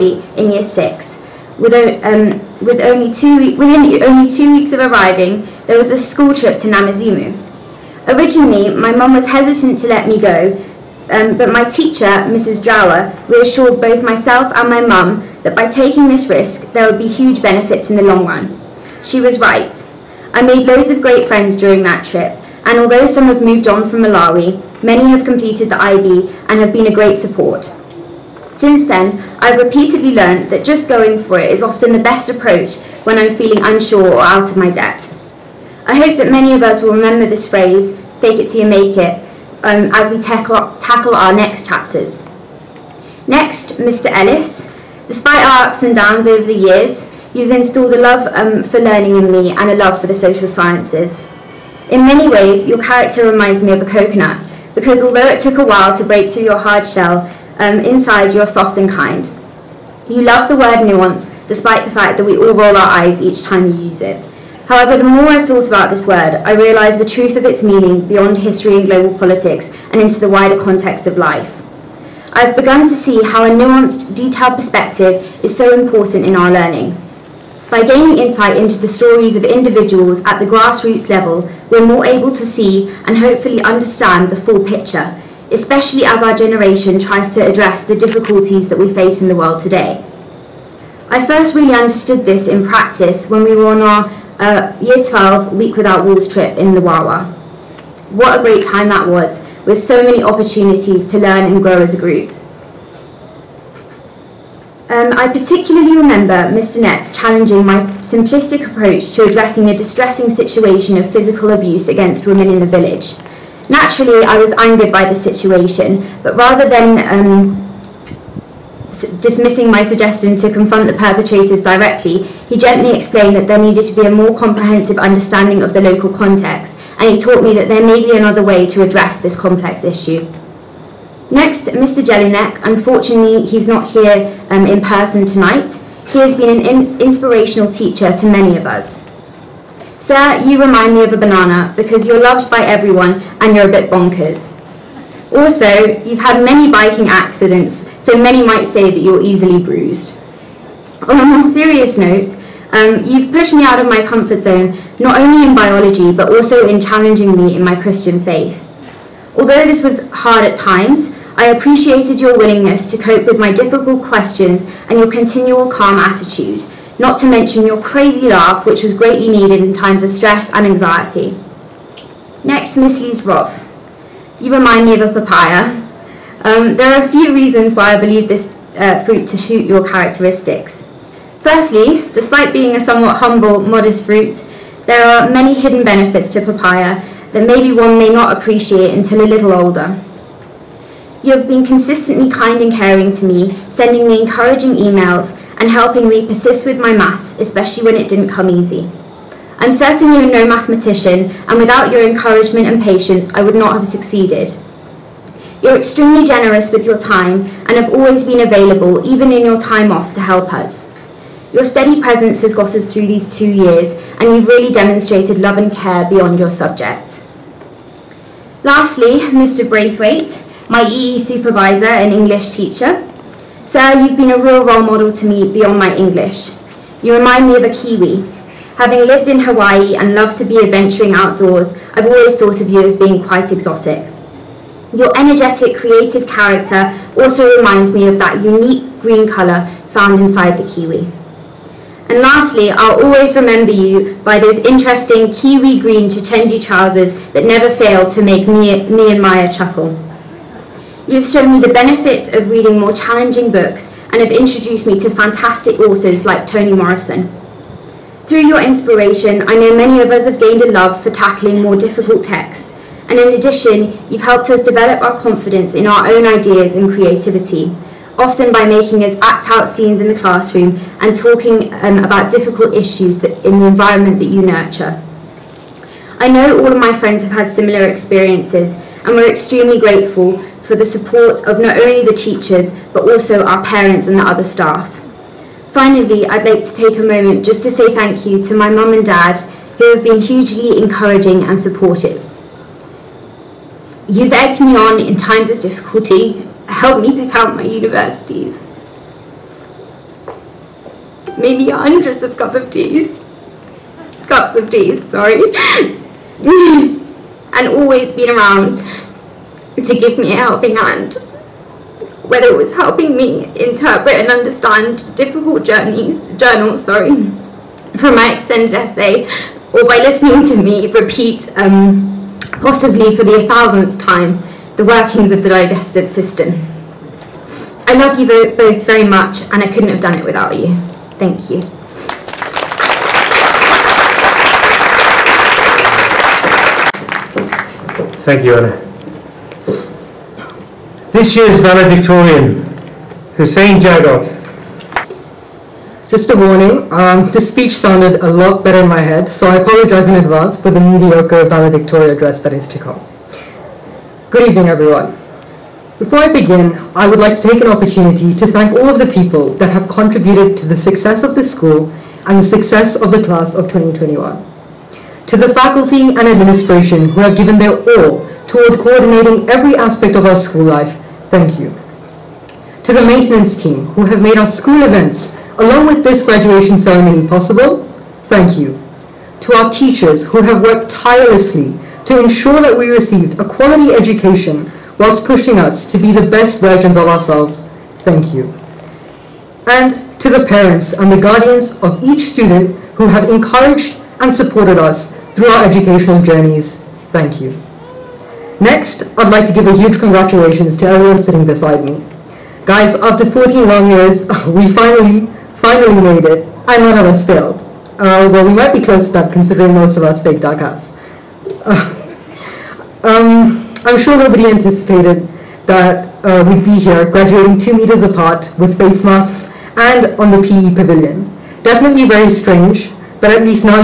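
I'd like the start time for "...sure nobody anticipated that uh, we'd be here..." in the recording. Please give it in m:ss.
6:53.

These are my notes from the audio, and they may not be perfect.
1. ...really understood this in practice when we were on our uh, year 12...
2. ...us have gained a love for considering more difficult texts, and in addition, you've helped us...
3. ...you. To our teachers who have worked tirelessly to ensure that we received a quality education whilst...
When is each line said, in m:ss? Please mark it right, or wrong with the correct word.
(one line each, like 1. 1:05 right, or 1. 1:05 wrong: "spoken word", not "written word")
1. 1:31 right
2. 4:20 wrong: "tackling", not "considering"
3. 6:18 right.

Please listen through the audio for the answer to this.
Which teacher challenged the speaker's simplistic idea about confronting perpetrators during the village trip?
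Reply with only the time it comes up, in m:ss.
1:46.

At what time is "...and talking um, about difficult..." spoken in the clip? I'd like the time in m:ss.
4:31.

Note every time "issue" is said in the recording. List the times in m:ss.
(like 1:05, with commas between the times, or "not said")
2:09, 4:32.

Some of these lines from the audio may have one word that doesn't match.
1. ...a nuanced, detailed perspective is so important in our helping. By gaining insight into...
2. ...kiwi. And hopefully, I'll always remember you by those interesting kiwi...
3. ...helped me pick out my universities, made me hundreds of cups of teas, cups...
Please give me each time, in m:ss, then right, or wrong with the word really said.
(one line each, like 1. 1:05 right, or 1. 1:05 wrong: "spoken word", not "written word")
1. 1:13 wrong: "learning", not "helping"
2. 4:00 wrong: "lastly", not "hopefully"
3. 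4:56 right.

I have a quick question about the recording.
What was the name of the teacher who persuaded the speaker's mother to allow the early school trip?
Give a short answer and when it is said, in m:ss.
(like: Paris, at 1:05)
Mrs. Drower, at 0:12.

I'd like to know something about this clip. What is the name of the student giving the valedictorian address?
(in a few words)
Hussein Jagot.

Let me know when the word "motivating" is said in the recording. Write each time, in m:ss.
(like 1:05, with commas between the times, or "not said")
not said.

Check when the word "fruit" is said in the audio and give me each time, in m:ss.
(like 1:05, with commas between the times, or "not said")
2:59, 3:04.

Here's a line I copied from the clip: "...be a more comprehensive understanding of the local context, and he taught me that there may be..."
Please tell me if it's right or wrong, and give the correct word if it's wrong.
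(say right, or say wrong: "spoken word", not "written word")
right.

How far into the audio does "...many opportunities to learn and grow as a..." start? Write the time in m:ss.
1:40.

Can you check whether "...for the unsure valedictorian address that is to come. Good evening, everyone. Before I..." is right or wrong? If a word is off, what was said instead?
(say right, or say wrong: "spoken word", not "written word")
wrong: "mediocre", not "unsure".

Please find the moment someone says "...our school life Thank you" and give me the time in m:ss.
6:10.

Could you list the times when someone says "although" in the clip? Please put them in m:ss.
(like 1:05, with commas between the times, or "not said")
0:22, 0:55, 2:39.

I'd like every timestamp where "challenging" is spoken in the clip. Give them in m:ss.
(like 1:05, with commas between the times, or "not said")
1:47, 2:36, 4:12.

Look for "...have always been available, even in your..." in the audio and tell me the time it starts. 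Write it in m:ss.
3:27.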